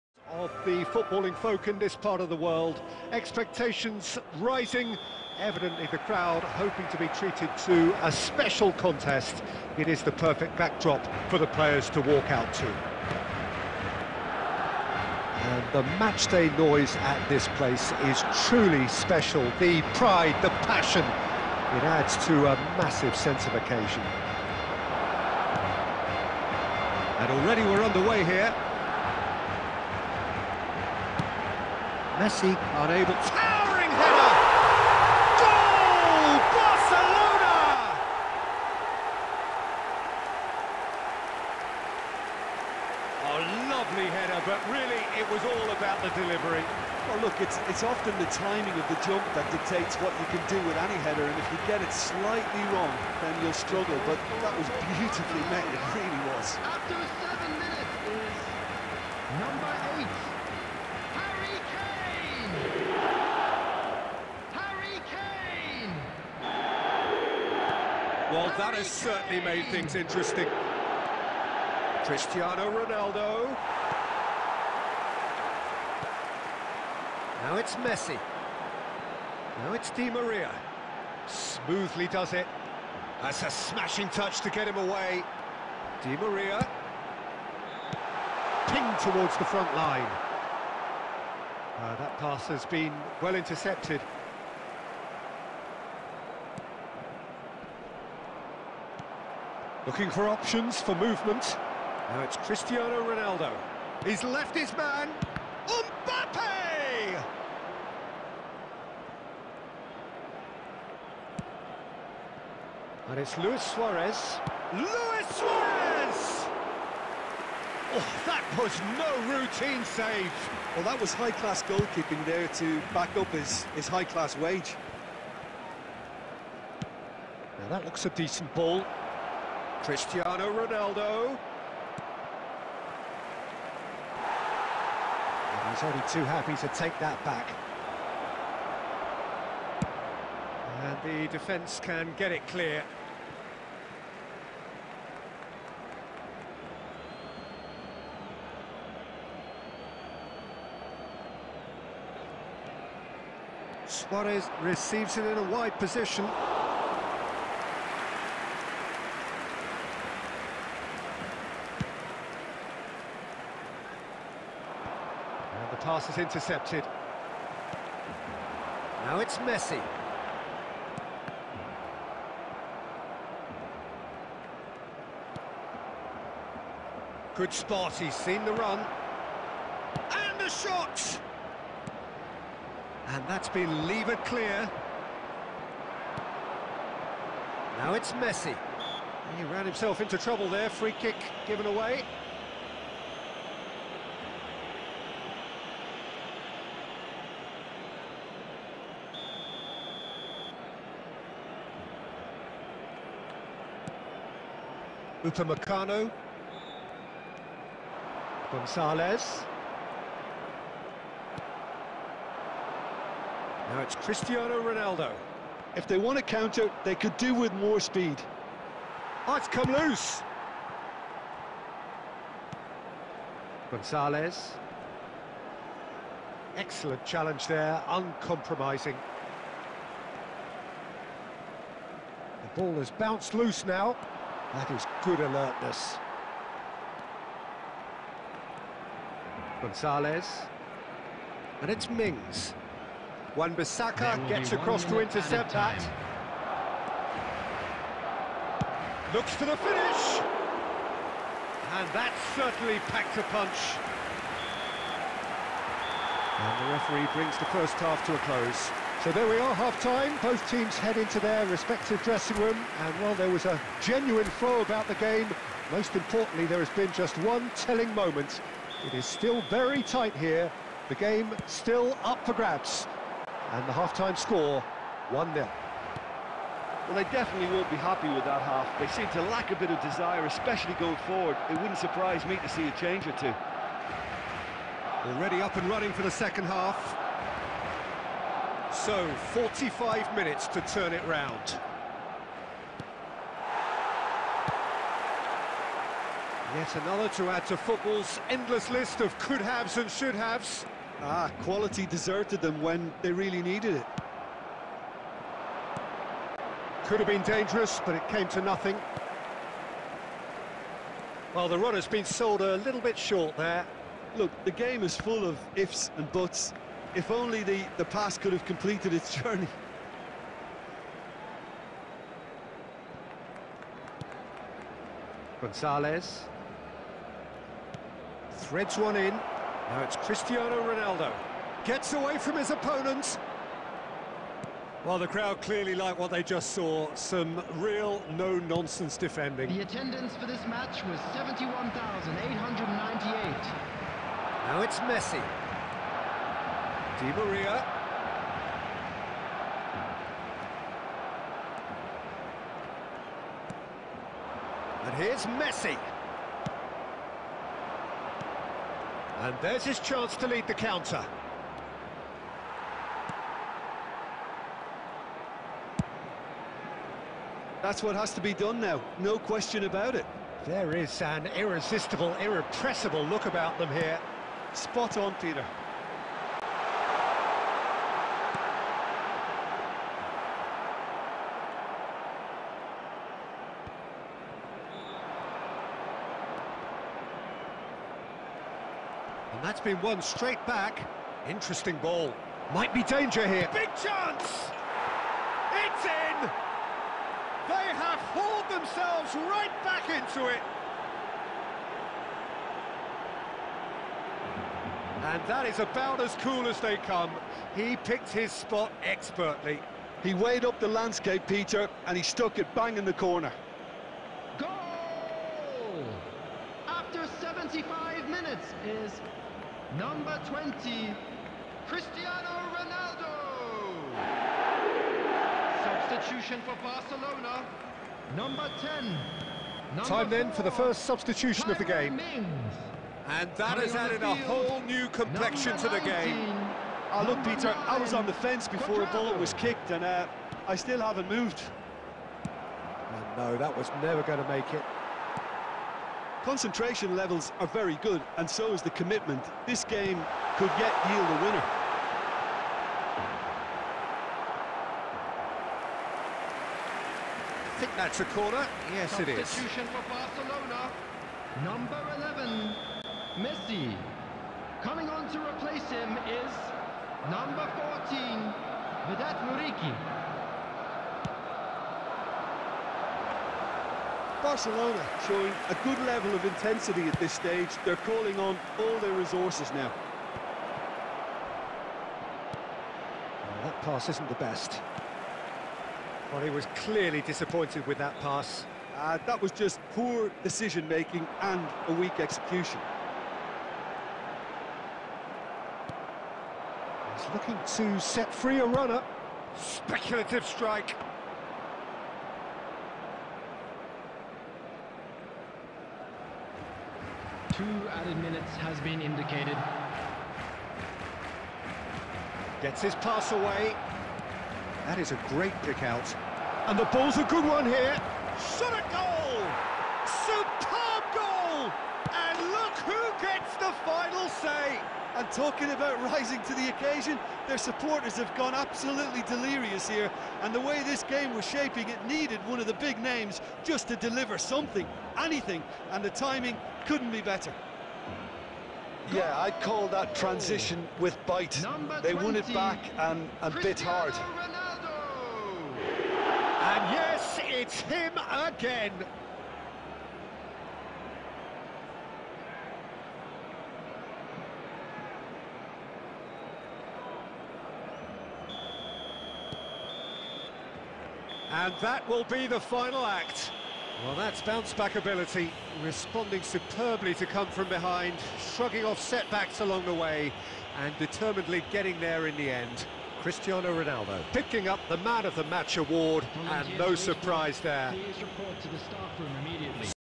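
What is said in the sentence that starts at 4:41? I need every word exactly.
It wouldn't surprise me to see a change or two.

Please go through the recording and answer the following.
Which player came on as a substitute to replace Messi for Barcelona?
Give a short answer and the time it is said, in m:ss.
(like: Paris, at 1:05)
Vedat Muriqi, at 7:48.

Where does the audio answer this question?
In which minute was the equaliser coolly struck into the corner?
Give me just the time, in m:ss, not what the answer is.
6:57.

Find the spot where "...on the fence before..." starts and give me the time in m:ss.
7:17.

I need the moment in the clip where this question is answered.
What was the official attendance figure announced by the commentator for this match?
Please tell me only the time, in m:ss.
5:41.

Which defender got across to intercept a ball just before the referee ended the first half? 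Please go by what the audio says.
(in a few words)
Wan-Bissaka.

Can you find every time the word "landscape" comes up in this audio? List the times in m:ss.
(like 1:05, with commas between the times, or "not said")
6:50.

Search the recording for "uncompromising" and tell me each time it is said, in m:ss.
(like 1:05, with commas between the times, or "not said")
3:47.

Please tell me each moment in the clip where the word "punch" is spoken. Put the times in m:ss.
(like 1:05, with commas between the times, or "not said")
4:13.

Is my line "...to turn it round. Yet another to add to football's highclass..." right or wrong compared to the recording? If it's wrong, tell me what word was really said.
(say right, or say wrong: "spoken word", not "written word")
wrong: "endless", not "highclass".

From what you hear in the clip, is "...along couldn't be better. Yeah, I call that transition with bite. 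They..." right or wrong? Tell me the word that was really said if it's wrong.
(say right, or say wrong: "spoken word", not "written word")
wrong: "timing", not "along".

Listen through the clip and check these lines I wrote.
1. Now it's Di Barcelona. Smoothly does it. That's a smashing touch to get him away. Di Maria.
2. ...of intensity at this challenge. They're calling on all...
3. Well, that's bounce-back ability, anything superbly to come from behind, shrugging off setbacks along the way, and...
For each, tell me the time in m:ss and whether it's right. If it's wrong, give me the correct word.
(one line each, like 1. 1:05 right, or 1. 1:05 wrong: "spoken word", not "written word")
1. 1:19 wrong: "Maria", not "Barcelona"
2. 7:56 wrong: "stage", not "challenge"
3. 9:23 wrong: "responding", not "anything".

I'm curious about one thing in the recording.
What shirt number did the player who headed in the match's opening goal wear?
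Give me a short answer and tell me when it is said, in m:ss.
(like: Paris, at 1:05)
8, at 0:59.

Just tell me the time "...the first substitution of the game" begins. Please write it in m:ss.
7:10.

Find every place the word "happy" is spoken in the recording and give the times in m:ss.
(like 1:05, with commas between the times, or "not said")
2:16, 4:37.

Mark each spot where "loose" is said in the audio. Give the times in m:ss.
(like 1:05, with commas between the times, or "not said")
3:39, 3:53.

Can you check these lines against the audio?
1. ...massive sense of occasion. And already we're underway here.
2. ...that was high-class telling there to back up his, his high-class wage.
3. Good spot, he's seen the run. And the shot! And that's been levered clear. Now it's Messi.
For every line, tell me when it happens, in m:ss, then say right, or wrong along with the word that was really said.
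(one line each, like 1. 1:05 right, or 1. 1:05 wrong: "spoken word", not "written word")
1. 0:22 right
2. 2:00 wrong: "goalkeeping", not "telling"
3. 2:57 right.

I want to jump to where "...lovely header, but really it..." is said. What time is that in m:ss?
0:43.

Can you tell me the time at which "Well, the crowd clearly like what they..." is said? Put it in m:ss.
5:34.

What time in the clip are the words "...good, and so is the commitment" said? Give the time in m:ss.
7:27.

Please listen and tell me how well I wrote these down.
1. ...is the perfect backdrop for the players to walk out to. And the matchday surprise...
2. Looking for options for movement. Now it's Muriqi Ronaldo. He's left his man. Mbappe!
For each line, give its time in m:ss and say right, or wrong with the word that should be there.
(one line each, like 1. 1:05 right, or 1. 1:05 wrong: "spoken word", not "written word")
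1. 0:09 wrong: "noise", not "surprise"
2. 1:39 wrong: "Cristiano", not "Muriqi".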